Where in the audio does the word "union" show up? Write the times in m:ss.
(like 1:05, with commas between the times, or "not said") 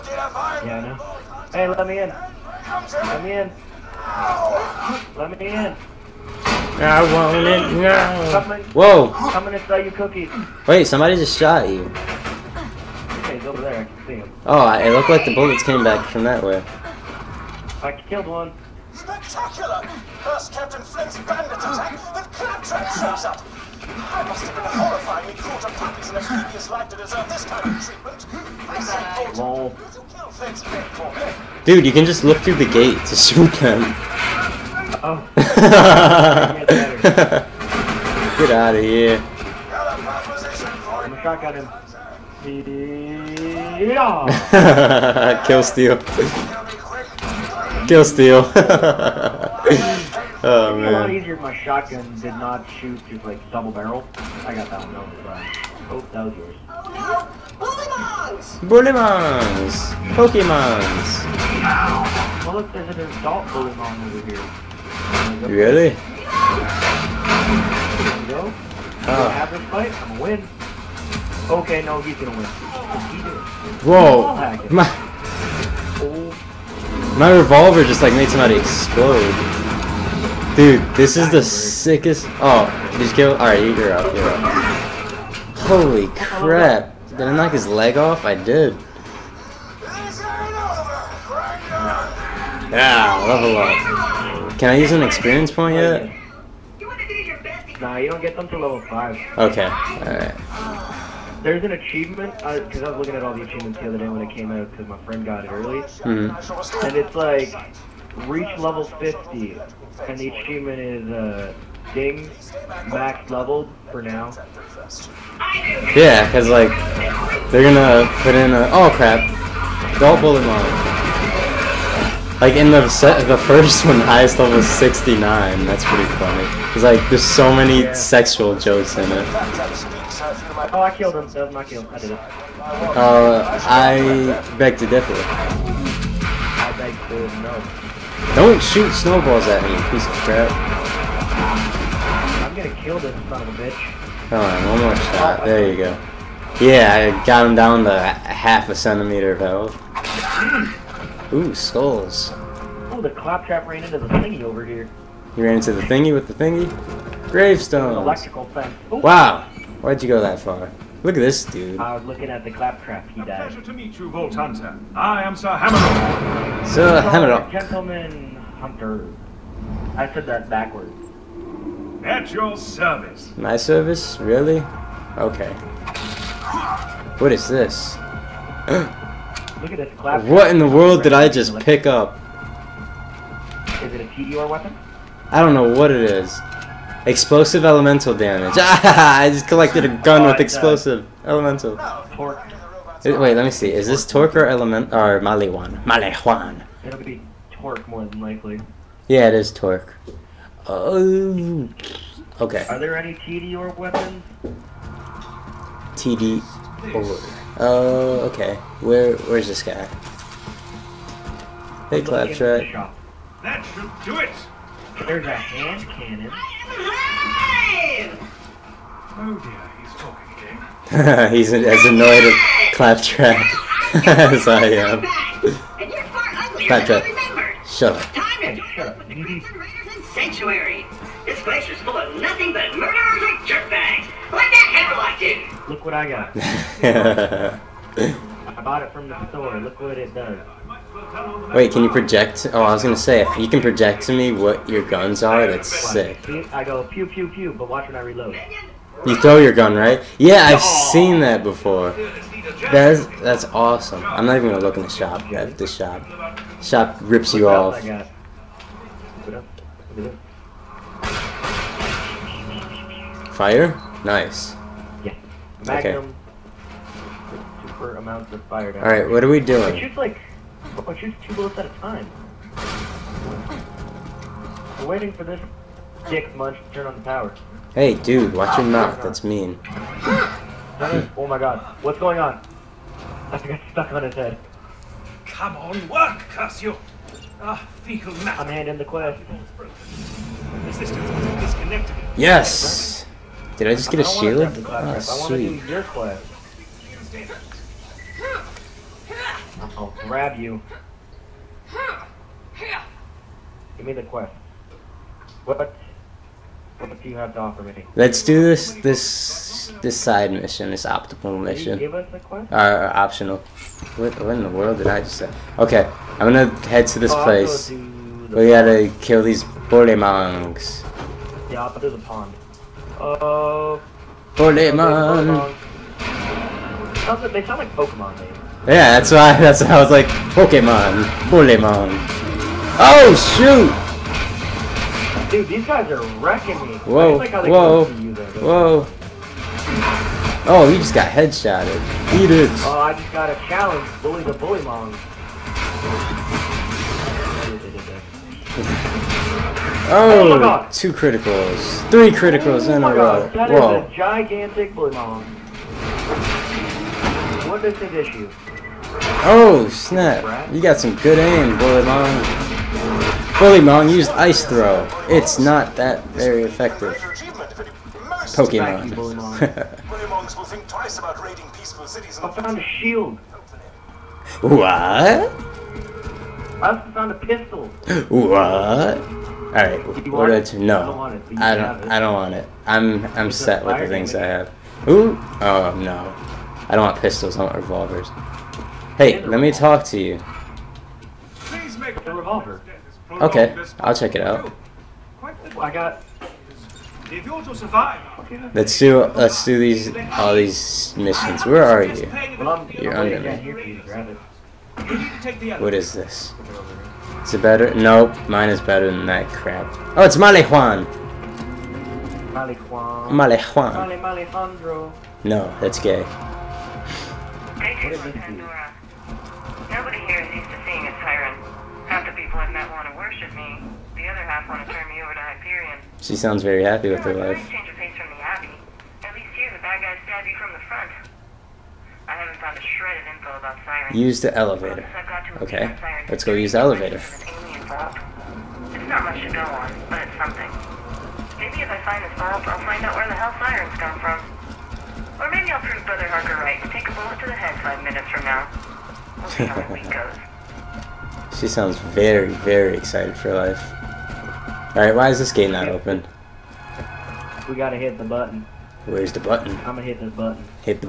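not said.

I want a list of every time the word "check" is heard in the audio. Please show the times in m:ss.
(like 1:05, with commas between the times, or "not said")
6:33.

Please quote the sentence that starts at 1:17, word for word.
my revolver just, like, made somebody explode.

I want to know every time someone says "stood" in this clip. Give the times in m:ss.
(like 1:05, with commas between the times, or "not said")
not said.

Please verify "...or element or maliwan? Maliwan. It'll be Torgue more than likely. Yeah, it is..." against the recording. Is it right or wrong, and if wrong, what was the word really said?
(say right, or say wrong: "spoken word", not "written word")
right.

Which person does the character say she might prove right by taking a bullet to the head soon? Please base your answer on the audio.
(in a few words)
Brother Harker.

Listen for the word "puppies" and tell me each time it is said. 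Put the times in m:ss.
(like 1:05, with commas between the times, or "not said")
0:25.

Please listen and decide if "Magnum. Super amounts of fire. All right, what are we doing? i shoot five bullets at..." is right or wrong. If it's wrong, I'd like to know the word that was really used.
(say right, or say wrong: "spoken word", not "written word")
wrong: "two", not "five".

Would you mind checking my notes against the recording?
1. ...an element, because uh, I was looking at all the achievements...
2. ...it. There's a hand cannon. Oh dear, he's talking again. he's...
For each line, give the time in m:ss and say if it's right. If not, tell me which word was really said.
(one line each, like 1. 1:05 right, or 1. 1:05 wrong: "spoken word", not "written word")
1. 1:41 wrong: "achievement", not "element"
2. 3:34 right.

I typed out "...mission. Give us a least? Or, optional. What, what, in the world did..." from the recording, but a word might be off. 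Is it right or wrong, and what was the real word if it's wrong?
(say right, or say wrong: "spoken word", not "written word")
wrong: "quest", not "least".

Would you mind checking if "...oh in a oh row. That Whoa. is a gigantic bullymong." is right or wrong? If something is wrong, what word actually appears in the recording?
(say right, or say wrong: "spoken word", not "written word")
right.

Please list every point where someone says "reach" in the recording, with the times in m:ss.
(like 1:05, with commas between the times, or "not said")
1:48.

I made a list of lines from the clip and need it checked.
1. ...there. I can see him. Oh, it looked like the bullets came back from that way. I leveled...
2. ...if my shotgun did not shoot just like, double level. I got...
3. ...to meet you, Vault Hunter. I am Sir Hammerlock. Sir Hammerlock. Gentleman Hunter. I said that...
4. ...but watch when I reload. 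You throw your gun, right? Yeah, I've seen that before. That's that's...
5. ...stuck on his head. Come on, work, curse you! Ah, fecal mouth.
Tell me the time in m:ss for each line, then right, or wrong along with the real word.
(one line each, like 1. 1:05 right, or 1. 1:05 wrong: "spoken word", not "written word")
1. 0:13 wrong: "killed", not "leveled"
2. 0:51 wrong: "barrel", not "level"
3. 2:43 right
4. 4:07 right
5. 4:43 right.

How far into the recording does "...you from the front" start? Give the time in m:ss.
7:10.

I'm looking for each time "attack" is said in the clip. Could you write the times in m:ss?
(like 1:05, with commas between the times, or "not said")
0:21.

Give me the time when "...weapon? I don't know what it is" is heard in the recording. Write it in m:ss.
3:04.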